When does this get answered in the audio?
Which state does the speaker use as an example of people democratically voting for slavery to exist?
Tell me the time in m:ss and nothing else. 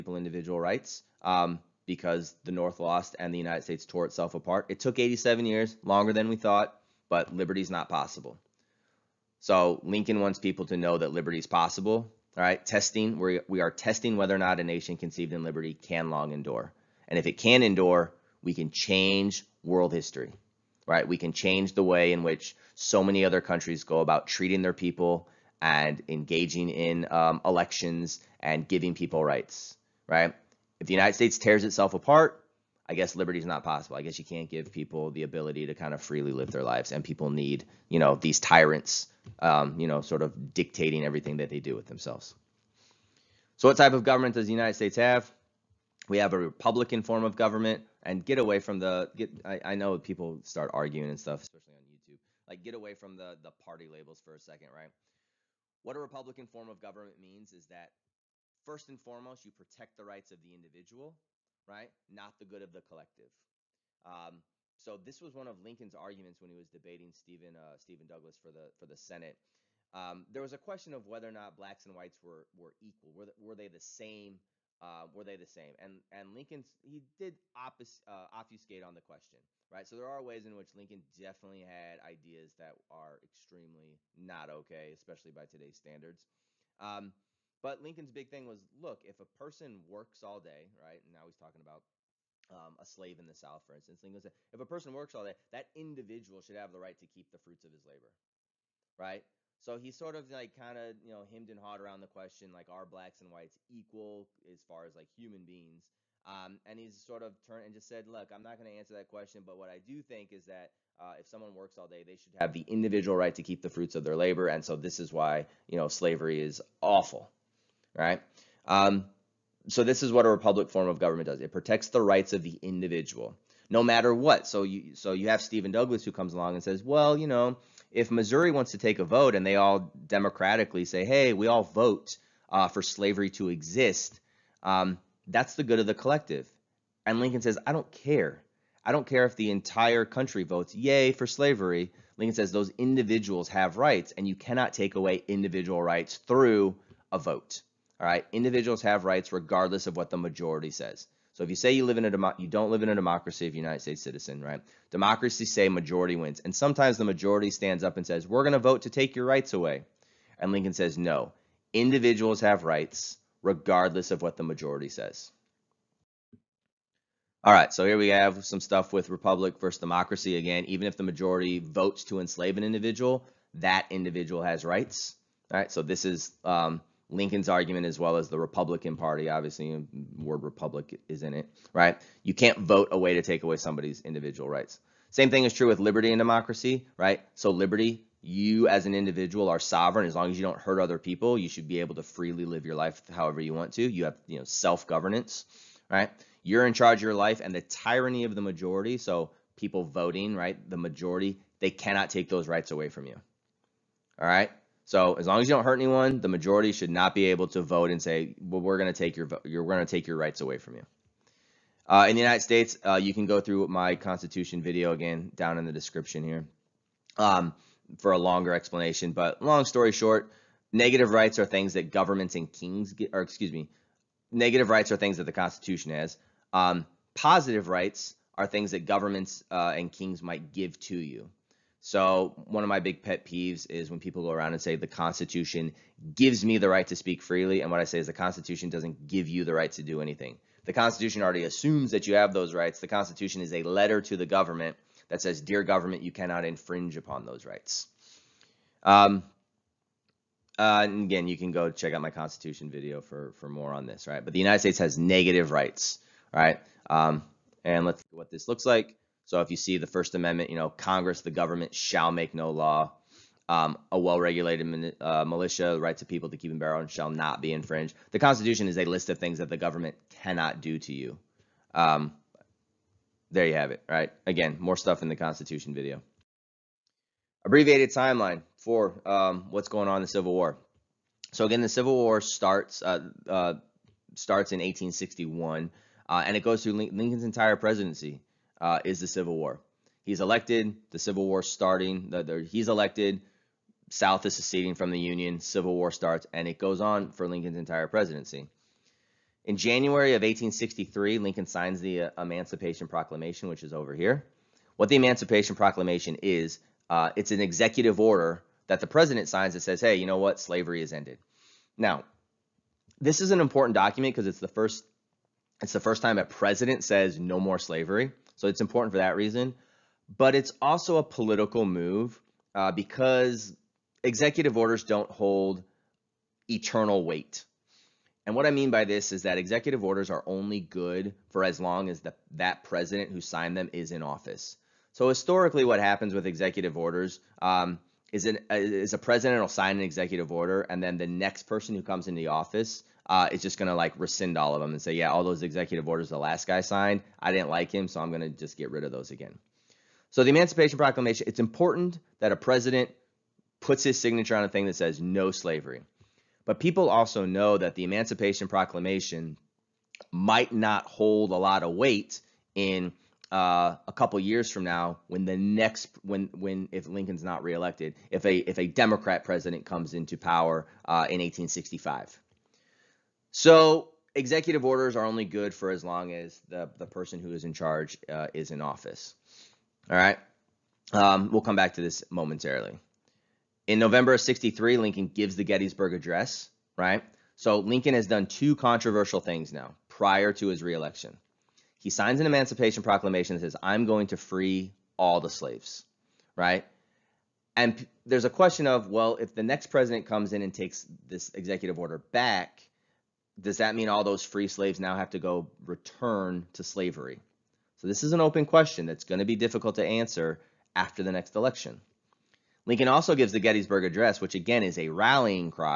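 2:08.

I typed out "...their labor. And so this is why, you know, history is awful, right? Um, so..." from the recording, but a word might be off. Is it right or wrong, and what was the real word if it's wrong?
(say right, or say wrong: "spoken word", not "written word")
wrong: "slavery", not "history".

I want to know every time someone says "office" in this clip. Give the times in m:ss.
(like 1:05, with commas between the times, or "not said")
5:34, 5:42, 6:18.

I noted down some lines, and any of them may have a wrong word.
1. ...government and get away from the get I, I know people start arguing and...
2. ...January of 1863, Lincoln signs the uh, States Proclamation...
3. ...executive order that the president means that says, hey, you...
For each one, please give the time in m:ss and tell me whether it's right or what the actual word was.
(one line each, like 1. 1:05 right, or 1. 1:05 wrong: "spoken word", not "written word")
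1. 0:47 right
2. 4:59 wrong: "Emancipation", not "States"
3. 5:07 wrong: "signs", not "means".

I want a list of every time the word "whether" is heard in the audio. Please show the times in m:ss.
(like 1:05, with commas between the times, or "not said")
0:14, 1:11.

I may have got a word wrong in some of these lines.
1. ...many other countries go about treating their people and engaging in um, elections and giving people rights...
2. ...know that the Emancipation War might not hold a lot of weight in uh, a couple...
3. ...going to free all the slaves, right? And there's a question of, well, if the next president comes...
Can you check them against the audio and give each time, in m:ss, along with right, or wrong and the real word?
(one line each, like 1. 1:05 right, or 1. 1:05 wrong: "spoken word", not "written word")
1. 0:23 right
2. 5:57 wrong: "Proclamation", not "War"
3. 6:33 right.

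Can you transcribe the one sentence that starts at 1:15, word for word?
And and Lincoln he did opus, uh, obfuscate on the question, right?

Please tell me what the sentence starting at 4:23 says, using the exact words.
Um, a well-regulated uh, militia, the rights of people to keep and bear arms shall not be infringed.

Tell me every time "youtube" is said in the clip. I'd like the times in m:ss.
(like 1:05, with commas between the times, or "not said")
0:51.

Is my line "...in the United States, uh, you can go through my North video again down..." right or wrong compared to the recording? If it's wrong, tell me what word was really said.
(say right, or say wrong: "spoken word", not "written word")
wrong: "Constitution", not "North".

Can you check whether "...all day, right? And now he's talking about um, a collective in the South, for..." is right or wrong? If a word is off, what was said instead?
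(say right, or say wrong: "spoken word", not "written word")
wrong: "slave", not "collective".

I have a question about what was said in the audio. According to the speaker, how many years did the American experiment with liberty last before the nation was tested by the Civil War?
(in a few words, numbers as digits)
87.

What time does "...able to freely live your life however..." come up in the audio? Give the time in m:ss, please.
3:11.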